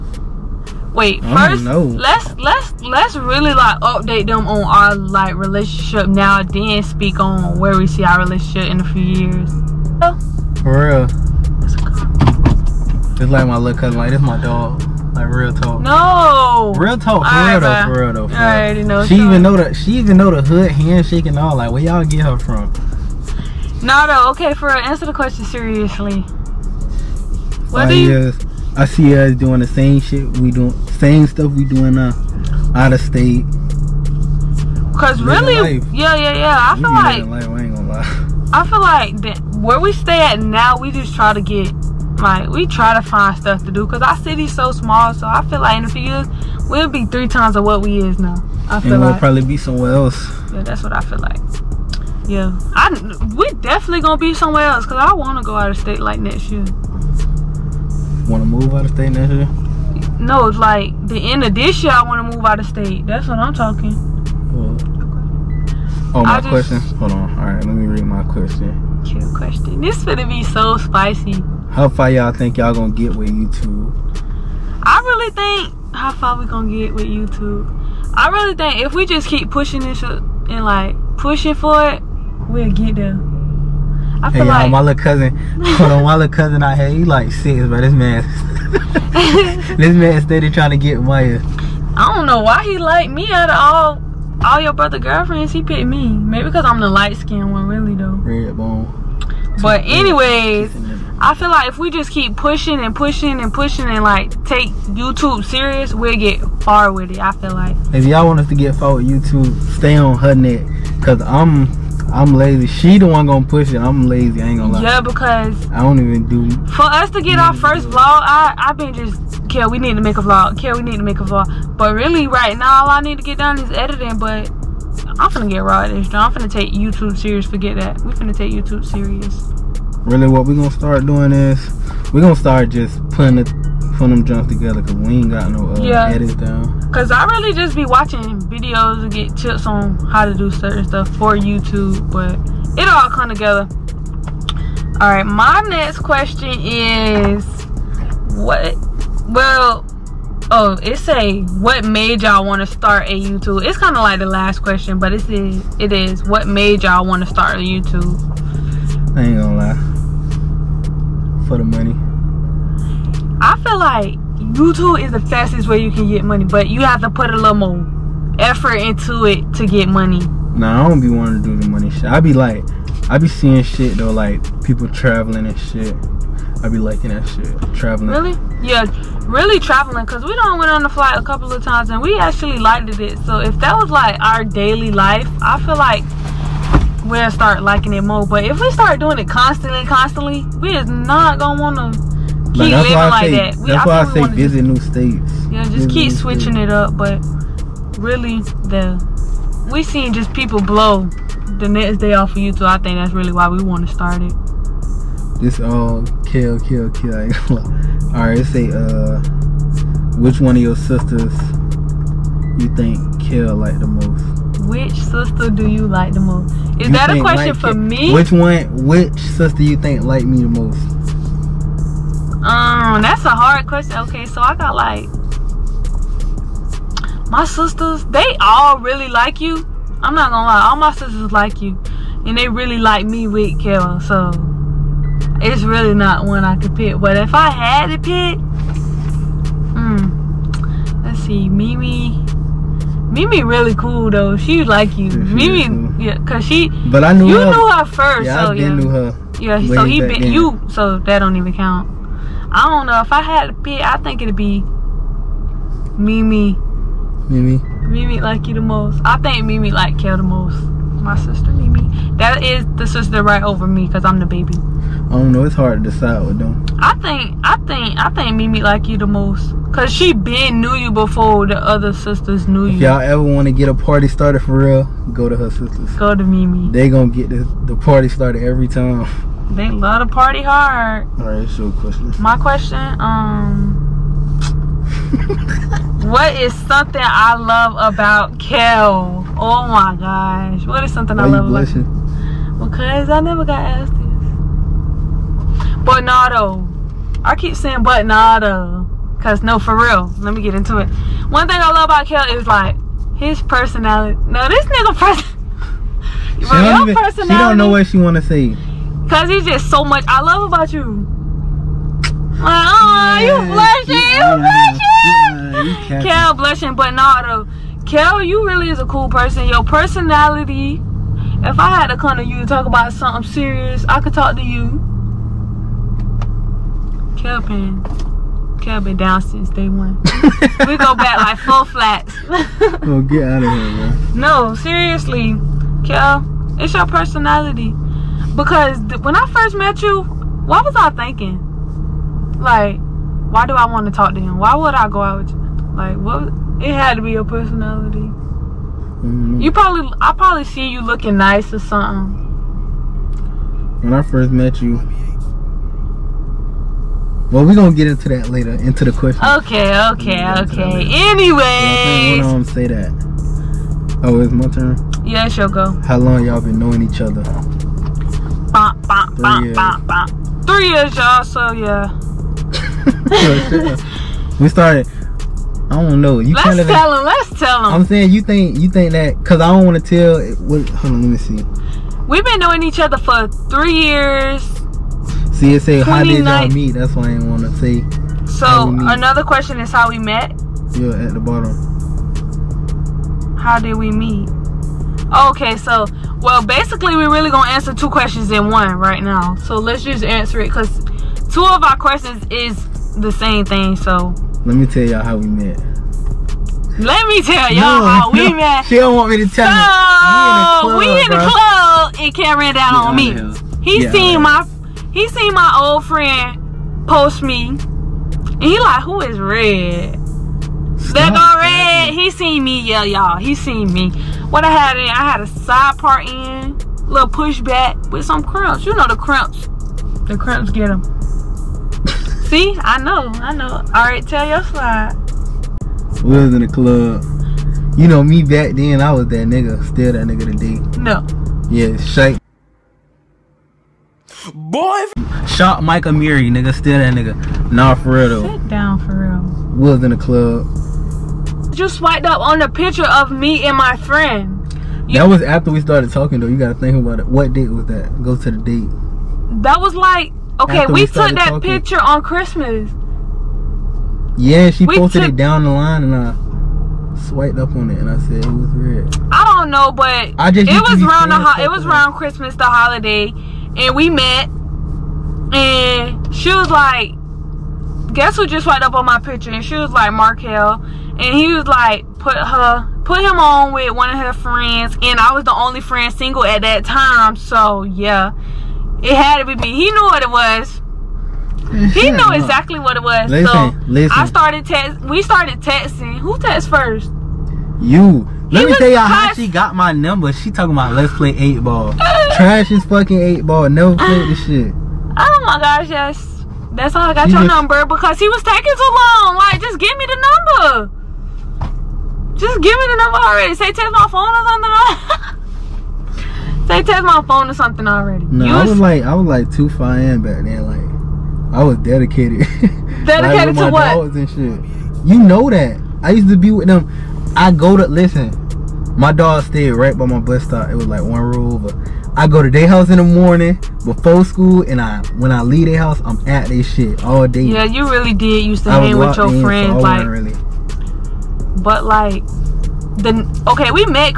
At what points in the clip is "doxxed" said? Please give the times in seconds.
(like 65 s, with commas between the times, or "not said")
not said.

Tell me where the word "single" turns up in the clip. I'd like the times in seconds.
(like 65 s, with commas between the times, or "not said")
485 s.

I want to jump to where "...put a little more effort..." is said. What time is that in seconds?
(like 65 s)
167 s.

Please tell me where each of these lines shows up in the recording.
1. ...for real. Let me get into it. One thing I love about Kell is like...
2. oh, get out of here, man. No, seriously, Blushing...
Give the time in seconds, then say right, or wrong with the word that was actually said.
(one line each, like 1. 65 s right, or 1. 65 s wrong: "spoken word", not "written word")
1. 299 s right
2. 332 s wrong: "Kell", not "Blushing".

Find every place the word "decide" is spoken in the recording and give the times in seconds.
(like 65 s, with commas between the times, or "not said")
265 s.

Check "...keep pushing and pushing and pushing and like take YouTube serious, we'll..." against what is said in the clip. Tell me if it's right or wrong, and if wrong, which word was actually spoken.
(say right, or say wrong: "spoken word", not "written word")
right.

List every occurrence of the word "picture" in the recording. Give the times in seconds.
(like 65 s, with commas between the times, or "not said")
452 s, 461 s, 478 s.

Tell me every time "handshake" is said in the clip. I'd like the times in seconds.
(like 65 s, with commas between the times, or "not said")
20 s.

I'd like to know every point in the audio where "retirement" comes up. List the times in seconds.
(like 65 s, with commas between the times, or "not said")
not said.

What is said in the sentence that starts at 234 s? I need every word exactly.
So it's really not one I could pick.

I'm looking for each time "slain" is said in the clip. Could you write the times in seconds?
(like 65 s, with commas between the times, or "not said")
not said.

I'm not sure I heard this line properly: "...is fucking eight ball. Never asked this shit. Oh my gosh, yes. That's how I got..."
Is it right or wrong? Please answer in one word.
wrong.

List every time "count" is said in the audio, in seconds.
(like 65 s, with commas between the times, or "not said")
251 s.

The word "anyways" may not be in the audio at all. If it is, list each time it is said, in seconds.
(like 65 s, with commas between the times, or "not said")
99 s, 361 s.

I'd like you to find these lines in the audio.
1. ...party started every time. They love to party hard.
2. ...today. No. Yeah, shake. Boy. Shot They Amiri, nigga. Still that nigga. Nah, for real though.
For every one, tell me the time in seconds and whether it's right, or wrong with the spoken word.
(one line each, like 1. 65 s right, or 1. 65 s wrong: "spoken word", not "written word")
1. 277 s right
2. 440 s wrong: "Mike", not "They".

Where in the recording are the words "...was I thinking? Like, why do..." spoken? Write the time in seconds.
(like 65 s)
340 s.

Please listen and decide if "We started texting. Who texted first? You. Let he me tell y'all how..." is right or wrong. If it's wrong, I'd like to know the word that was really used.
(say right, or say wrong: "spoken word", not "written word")
right.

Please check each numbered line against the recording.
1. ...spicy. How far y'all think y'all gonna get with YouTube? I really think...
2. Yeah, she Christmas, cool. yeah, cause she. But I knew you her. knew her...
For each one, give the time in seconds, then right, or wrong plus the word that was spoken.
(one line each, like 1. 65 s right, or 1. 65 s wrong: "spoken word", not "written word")
1. 70 s right
2. 245 s wrong: "Mimi", not "Christmas".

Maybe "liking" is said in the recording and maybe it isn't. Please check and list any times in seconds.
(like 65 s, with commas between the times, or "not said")
176 s, 187 s.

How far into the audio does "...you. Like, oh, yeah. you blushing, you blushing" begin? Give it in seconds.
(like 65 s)
310 s.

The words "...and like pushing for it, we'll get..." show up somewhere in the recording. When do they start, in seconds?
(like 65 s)
80 s.